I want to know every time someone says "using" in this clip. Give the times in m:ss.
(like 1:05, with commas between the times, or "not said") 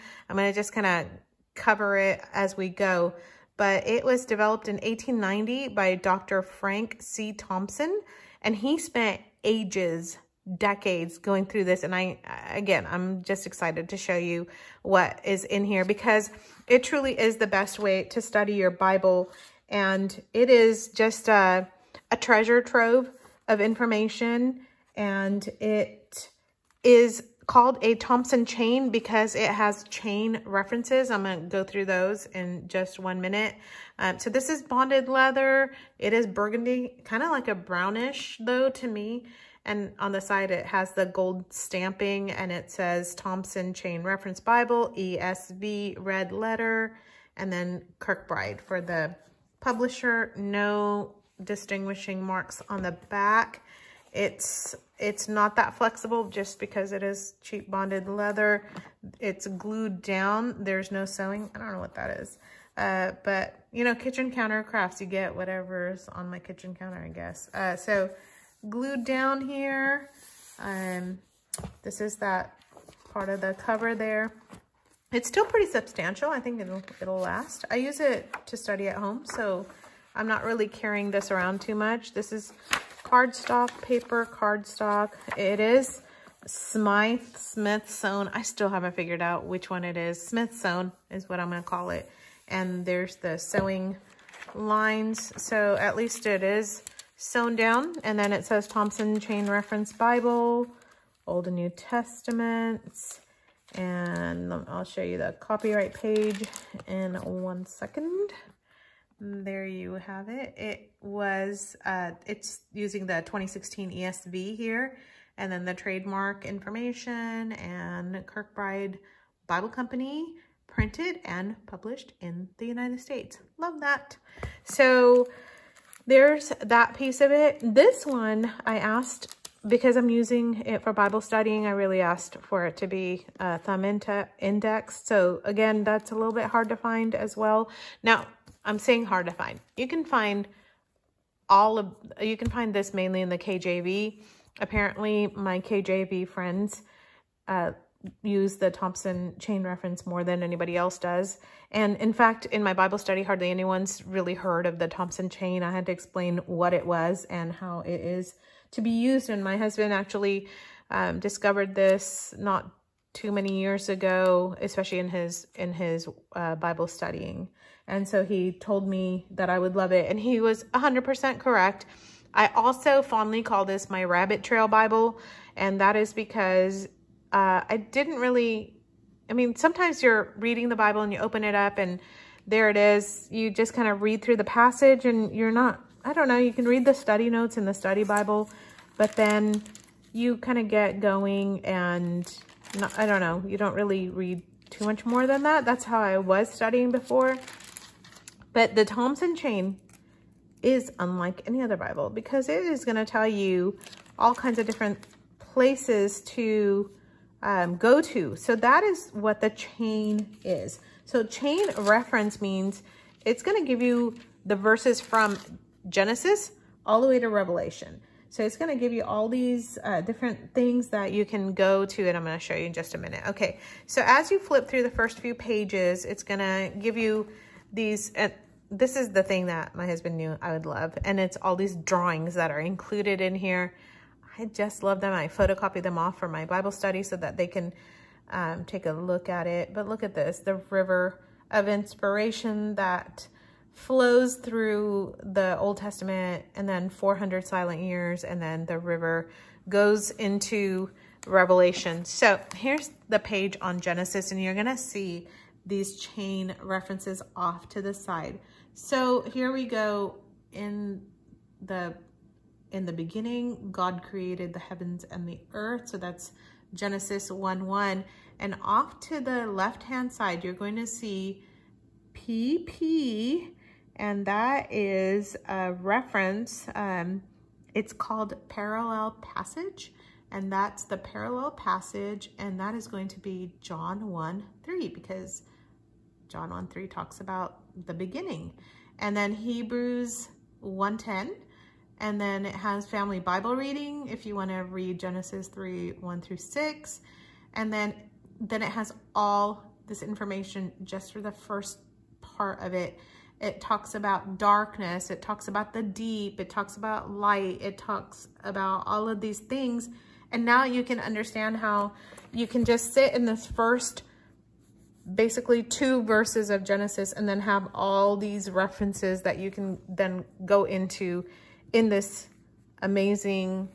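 1:52, 2:10.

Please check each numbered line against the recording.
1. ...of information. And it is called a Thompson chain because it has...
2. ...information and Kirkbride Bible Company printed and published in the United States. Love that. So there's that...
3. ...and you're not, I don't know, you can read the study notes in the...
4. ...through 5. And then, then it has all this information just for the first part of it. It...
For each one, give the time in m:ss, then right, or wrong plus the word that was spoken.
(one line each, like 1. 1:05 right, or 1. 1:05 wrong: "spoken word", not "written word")
1. 0:23 right
2. 1:56 right
3. 3:05 right
4. 4:56 wrong: "6", not "5".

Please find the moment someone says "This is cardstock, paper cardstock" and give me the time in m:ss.
1:22.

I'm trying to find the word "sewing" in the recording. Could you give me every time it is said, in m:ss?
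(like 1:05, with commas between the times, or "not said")
1:01, 1:33.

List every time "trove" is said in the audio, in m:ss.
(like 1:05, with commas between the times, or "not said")
0:22.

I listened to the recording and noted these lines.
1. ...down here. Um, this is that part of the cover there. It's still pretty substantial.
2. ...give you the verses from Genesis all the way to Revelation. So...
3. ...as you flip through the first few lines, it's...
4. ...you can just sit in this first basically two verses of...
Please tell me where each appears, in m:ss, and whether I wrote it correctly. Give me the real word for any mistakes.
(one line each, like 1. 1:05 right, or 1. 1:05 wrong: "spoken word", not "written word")
1. 1:09 right
2. 3:33 right
3. 3:44 wrong: "pages", not "lines"
4. 5:12 right.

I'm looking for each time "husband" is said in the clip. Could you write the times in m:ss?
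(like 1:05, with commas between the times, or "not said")
2:39, 3:49.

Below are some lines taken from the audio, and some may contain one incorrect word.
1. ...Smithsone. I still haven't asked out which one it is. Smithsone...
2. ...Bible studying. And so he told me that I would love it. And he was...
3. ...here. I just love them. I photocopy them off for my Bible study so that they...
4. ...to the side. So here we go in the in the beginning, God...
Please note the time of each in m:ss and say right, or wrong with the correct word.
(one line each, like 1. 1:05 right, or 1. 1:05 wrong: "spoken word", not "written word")
1. 1:27 wrong: "figured", not "asked"
2. 2:46 right
3. 3:53 right
4. 4:17 right.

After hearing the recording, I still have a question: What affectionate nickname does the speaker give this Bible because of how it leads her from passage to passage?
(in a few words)
rabbit trail Bible.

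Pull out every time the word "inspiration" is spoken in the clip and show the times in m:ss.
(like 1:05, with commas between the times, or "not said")
4:01.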